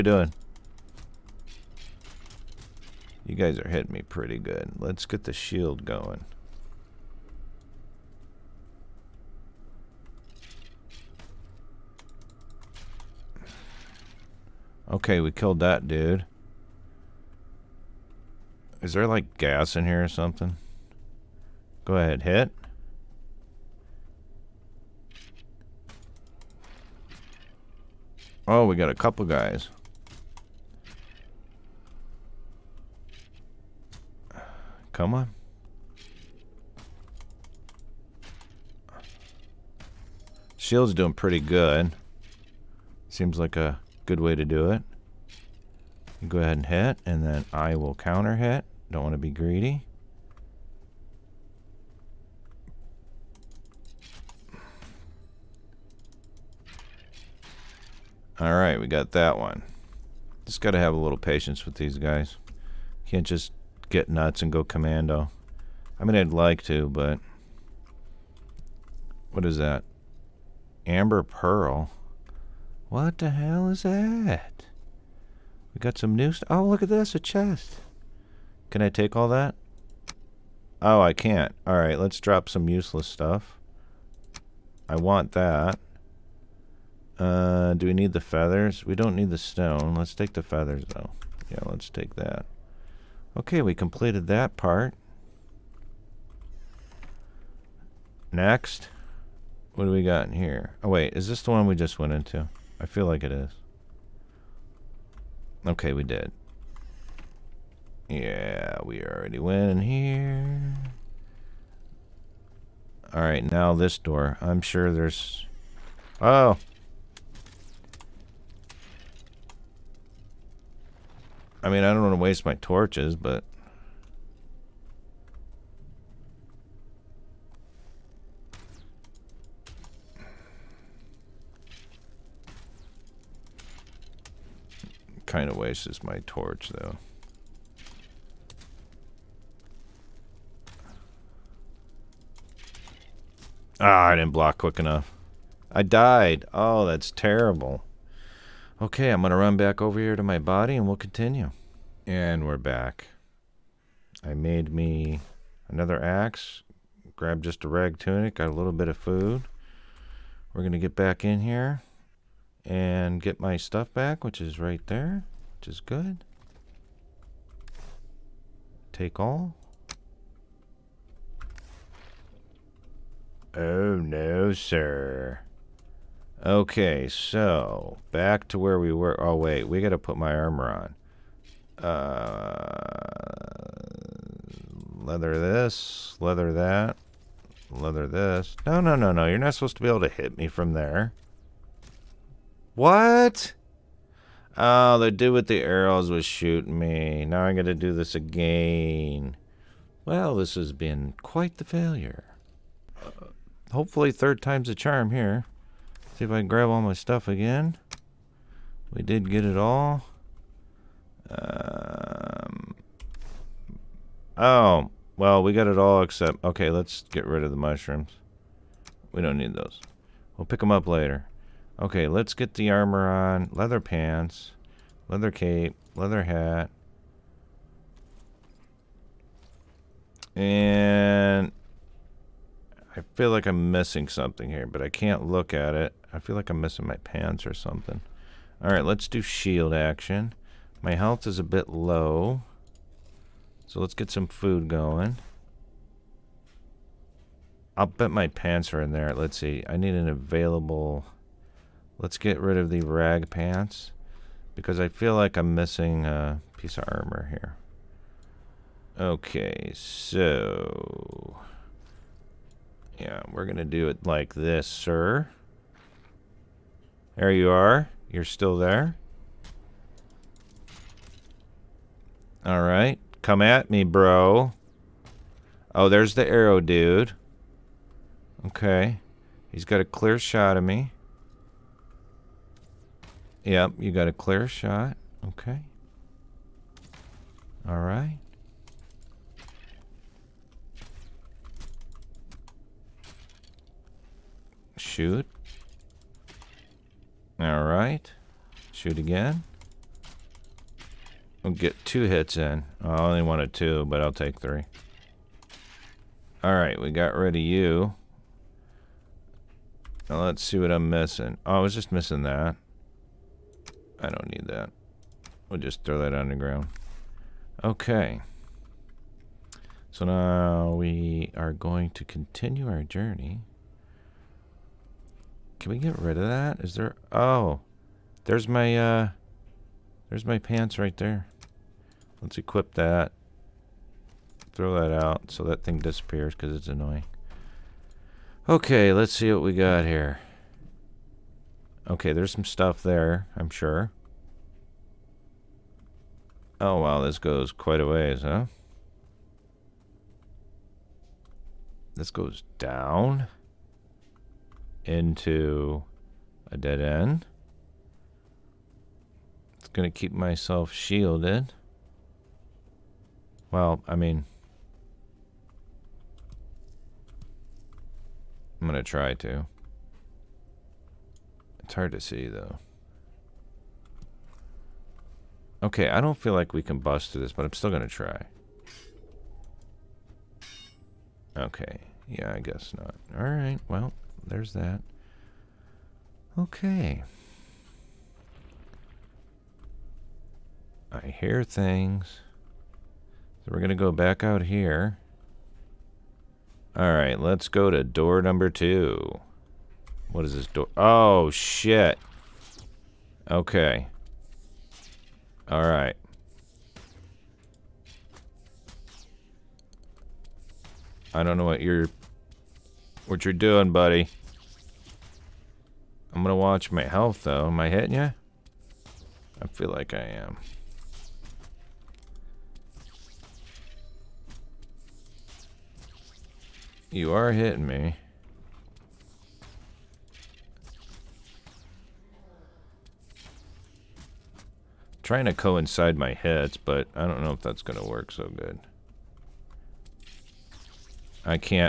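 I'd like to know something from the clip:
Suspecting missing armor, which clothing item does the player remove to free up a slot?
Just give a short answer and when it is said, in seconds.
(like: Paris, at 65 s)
rag pants, at 252 s.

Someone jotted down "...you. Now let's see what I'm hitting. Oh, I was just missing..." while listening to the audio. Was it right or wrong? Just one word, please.
wrong.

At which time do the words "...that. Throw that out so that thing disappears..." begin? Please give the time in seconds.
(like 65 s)
332 s.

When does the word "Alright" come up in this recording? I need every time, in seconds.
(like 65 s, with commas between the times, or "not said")
58 s, 81 s, 113 s.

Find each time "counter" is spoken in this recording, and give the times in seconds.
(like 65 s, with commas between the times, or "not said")
47 s.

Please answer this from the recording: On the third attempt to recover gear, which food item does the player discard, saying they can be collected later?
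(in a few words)
mushrooms.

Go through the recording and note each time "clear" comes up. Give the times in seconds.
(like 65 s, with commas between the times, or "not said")
279 s, 284 s.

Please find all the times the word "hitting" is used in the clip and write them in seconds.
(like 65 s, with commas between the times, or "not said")
3 s, 417 s, 427 s.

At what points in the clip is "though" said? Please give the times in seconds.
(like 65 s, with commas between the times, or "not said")
90 s, 136 s, 372 s, 417 s.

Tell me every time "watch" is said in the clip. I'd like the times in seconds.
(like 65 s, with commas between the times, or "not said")
416 s.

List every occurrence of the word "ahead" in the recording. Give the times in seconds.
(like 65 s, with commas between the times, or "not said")
21 s, 46 s.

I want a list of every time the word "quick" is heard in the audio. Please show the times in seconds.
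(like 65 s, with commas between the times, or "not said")
144 s.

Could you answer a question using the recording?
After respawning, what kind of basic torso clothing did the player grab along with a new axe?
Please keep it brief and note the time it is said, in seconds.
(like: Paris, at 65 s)
rag tunic, at 157 s.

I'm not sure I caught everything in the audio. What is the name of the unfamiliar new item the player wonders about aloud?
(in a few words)
Amber Pearl.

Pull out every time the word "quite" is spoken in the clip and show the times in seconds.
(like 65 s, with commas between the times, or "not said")
201 s, 347 s.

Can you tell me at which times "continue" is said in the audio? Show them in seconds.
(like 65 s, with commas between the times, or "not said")
150 s, 322 s.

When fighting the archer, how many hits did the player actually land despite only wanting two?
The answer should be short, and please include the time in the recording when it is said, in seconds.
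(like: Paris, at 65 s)
3, at 304 s.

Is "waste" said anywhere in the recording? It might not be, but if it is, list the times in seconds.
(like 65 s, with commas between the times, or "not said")
122 s, 135 s.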